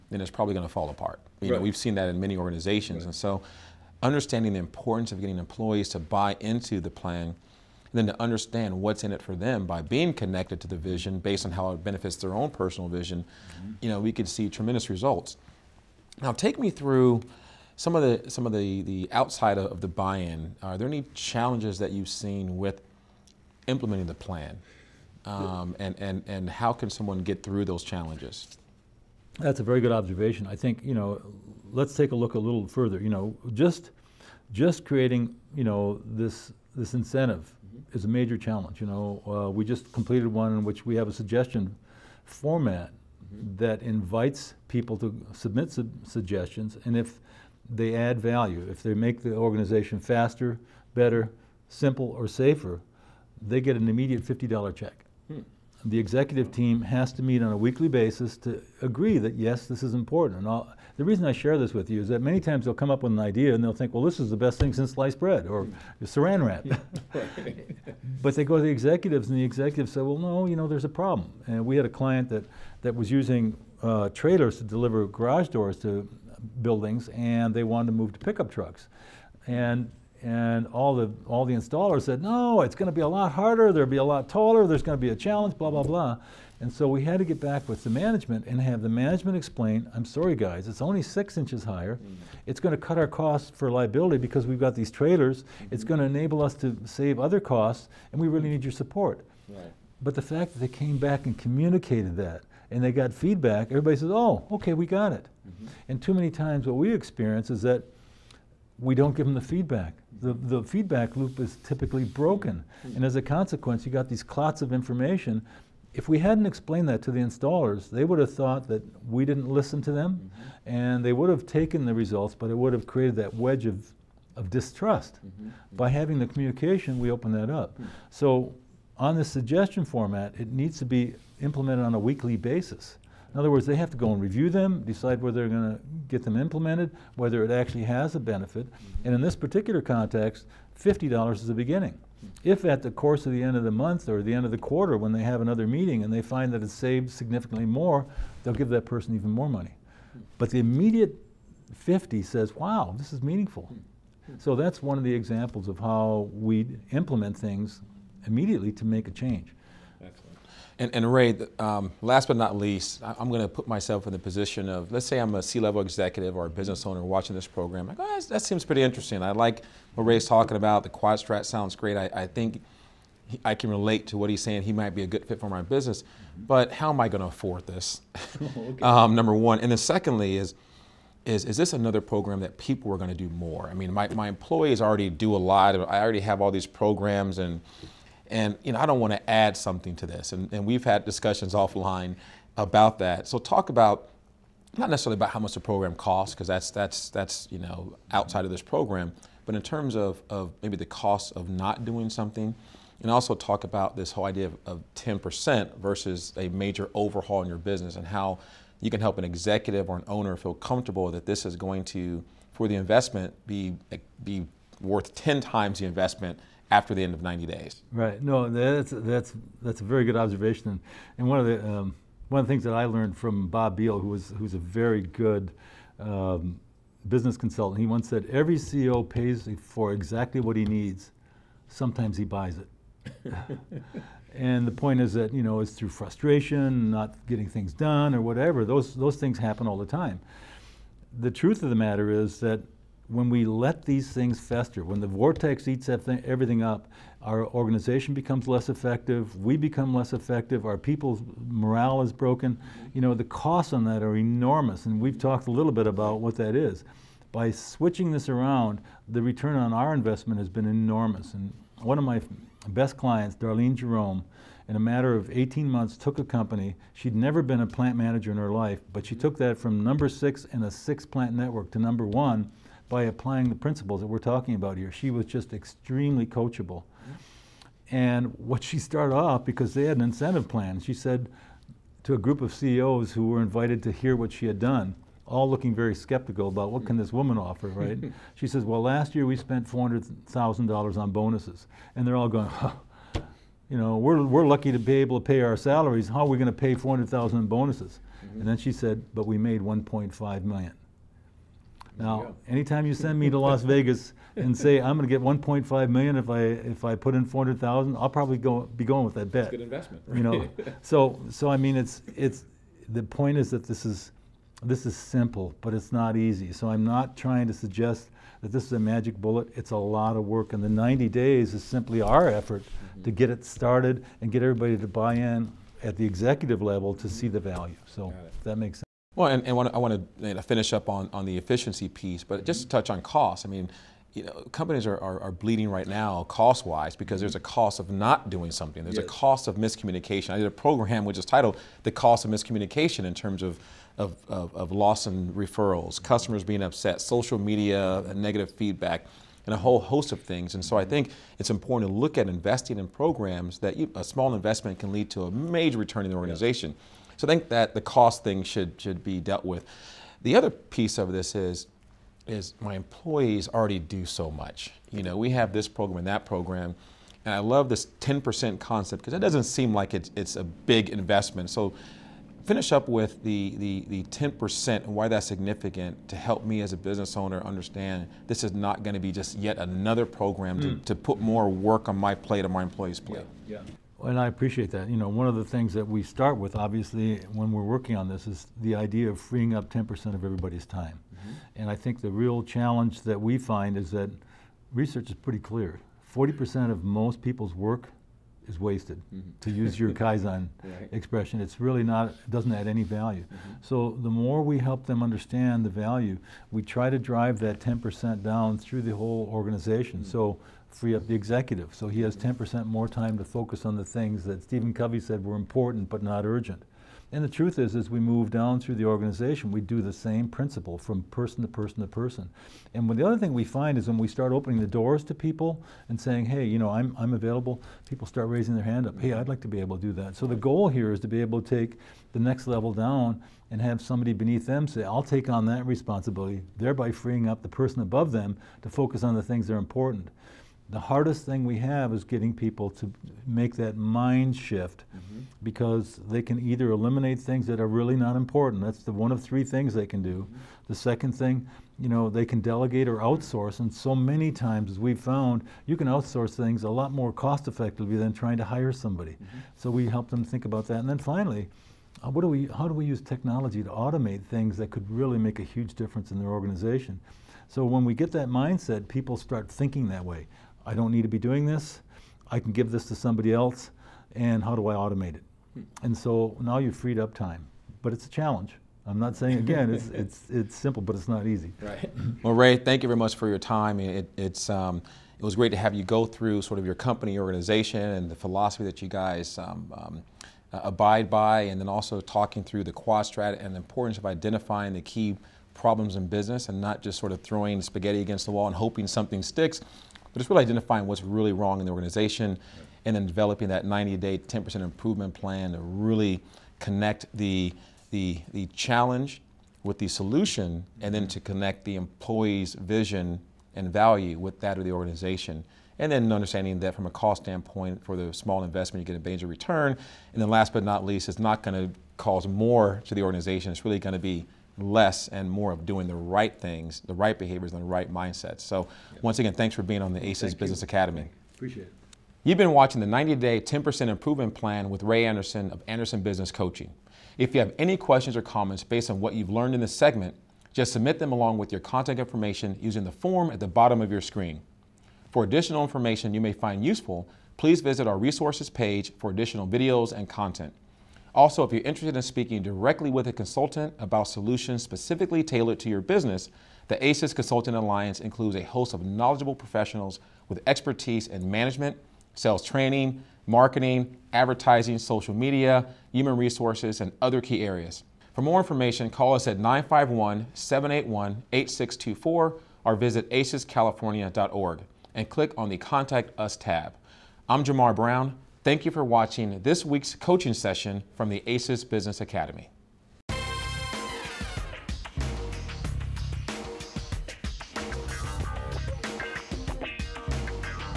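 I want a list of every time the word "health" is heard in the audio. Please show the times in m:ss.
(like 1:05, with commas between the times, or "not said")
not said.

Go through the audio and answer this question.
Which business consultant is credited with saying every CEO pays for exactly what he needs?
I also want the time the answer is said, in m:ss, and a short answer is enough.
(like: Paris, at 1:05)
Bob Beal, at 3:43.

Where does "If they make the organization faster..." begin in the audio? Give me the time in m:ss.
0:48.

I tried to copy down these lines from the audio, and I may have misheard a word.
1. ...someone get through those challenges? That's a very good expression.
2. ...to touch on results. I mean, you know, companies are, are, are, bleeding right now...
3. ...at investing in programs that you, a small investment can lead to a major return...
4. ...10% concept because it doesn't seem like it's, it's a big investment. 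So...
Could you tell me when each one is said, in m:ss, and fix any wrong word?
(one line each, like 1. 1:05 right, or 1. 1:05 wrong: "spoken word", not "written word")
1. 0:26 wrong: "observation", not "expression"
2. 5:32 wrong: "costs", not "results"
3. 5:52 right
4. 6:07 right.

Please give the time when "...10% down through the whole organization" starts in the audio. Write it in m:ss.
6:47.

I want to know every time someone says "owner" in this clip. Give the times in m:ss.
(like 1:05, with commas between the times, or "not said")
2:46, 3:30, 6:17.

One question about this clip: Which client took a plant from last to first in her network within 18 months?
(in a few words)
Darlene Jerome.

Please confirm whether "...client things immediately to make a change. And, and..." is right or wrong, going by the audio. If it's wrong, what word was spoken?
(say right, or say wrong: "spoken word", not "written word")
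wrong: "implement", not "client".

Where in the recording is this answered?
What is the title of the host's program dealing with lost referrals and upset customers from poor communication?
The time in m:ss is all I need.
5:41.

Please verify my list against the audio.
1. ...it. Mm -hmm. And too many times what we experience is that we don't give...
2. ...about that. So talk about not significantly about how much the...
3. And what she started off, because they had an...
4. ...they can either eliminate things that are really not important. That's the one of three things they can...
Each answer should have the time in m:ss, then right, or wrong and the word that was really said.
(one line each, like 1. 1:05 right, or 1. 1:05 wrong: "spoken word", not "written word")
1. 1:45 right
2. 3:12 wrong: "necessarily", not "significantly"
3. 4:37 right
4. 7:26 right.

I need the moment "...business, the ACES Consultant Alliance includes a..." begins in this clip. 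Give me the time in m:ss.
9:15.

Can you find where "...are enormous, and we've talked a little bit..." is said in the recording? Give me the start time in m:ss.
4:14.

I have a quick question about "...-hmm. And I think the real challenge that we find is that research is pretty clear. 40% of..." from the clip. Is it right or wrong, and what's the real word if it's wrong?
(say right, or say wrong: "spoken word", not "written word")
right.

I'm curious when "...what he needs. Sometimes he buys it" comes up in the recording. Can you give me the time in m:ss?
3:50.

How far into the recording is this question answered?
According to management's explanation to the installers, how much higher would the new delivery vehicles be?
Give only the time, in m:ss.
1:31.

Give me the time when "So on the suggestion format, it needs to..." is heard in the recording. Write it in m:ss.
2:08.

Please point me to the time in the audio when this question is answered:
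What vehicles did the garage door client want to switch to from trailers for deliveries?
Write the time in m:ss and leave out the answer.
1:18.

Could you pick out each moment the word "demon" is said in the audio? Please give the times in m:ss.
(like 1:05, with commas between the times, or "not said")
not said.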